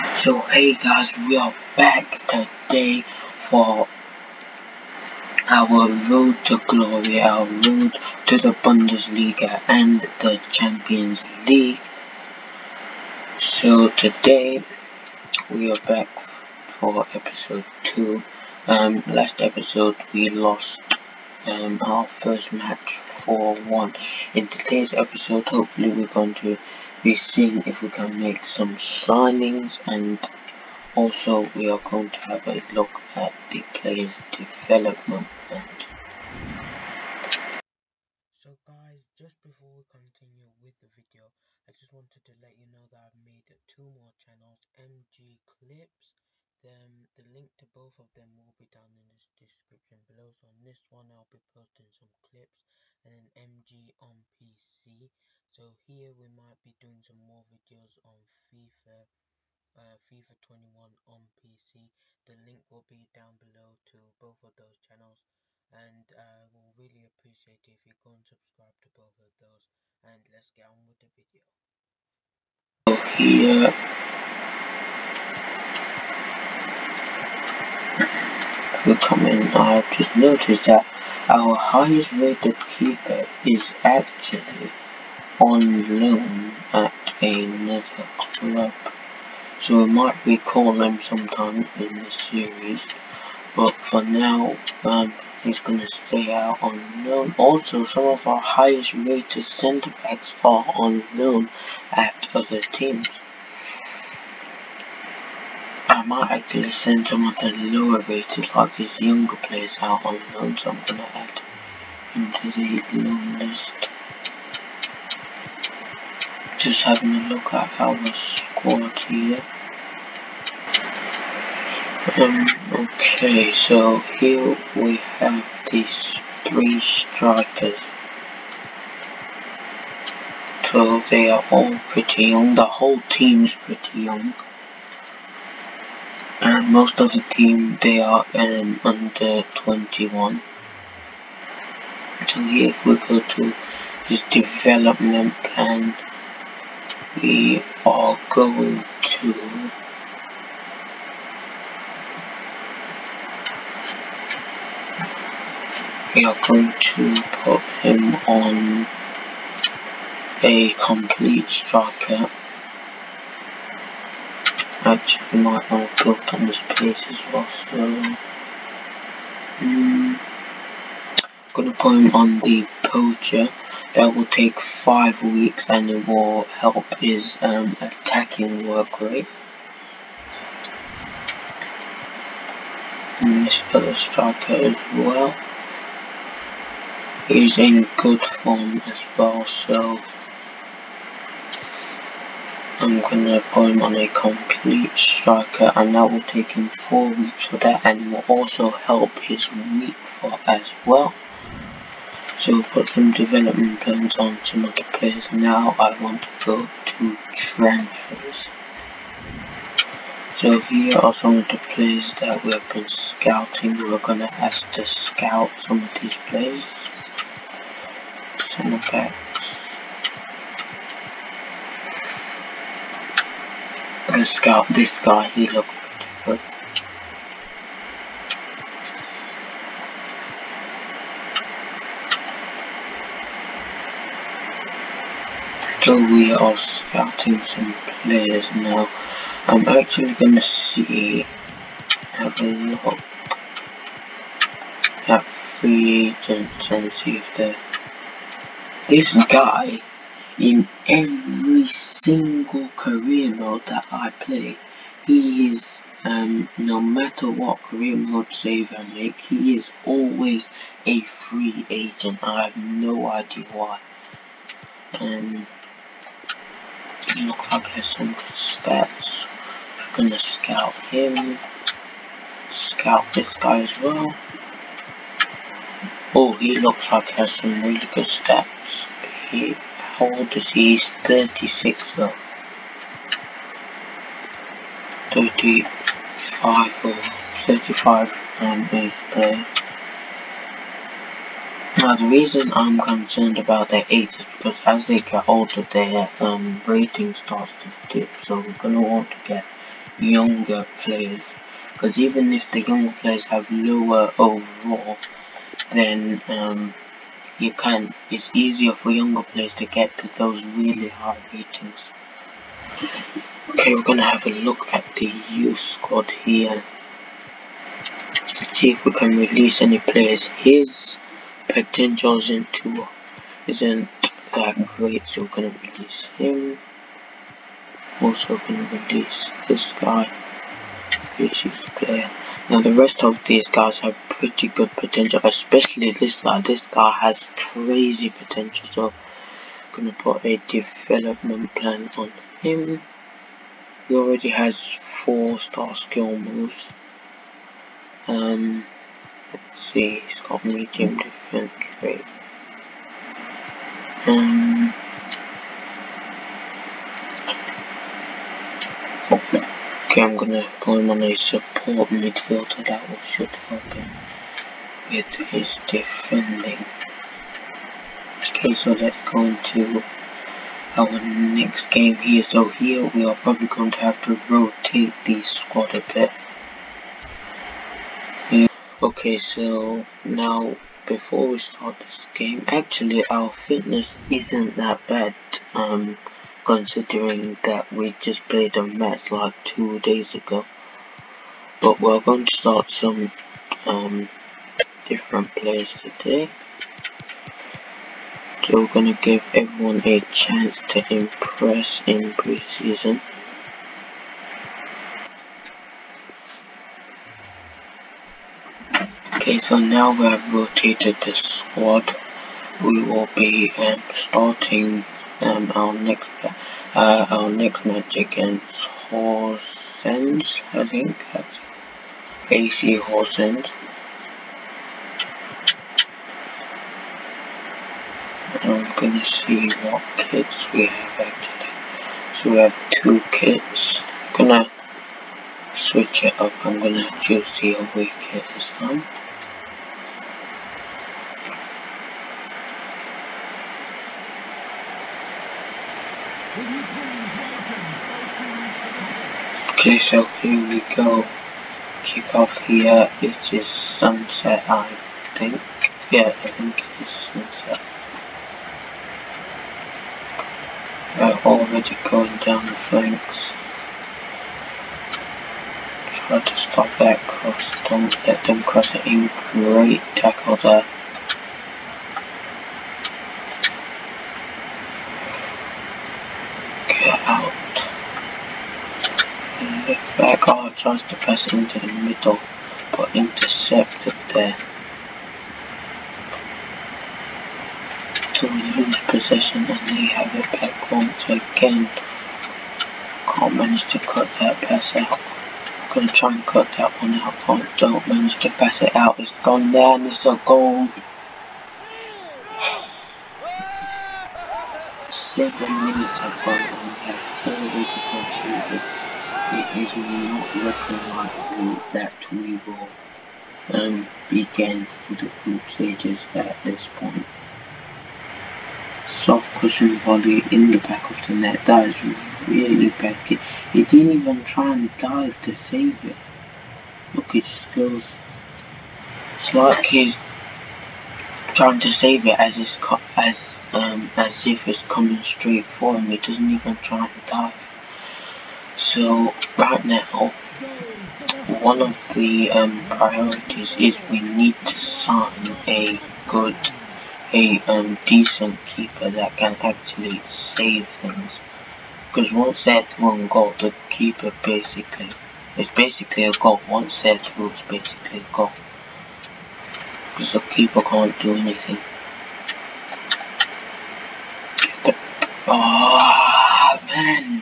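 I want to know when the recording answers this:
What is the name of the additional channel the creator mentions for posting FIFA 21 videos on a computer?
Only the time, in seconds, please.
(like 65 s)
53 s.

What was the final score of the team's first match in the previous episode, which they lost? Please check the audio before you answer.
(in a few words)
4-1.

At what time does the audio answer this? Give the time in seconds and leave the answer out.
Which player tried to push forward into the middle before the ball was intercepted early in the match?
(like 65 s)
480 s.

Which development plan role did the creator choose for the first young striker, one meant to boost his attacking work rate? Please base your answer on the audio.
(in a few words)
Poacher.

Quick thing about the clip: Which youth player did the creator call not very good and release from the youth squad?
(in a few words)
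Pectin Johnson.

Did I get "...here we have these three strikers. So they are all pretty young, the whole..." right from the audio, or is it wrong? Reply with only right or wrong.
right.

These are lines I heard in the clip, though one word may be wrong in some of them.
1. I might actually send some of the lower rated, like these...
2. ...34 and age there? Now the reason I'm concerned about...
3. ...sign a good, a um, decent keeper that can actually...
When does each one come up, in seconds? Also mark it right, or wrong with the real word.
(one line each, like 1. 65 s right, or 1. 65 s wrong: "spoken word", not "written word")
1. 105 s right
2. 287 s wrong: "35", not "34"
3. 544 s right.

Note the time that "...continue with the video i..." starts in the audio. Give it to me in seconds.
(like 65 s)
39 s.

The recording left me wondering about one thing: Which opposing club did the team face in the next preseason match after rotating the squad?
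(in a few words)
AC Horsens.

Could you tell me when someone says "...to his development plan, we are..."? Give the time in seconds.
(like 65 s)
143 s.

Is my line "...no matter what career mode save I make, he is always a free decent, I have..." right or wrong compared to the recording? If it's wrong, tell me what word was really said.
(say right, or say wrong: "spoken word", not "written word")
wrong: "agent", not "decent".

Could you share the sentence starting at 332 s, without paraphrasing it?
Now the rest of these guys have pretty good potential, especially this guy.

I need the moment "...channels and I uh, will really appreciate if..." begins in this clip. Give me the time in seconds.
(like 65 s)
64 s.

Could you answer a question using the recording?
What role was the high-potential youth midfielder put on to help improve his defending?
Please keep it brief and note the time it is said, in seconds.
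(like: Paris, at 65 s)
Support midfielder, at 361 s.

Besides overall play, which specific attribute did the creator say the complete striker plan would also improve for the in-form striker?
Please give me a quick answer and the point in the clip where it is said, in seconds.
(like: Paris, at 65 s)
Weak foot, at 199 s.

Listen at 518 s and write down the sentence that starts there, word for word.
Soft cushion volley in the back of the net, that is really bad.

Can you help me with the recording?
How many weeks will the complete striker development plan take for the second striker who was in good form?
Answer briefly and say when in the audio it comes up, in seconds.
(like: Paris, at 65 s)
4, at 196 s.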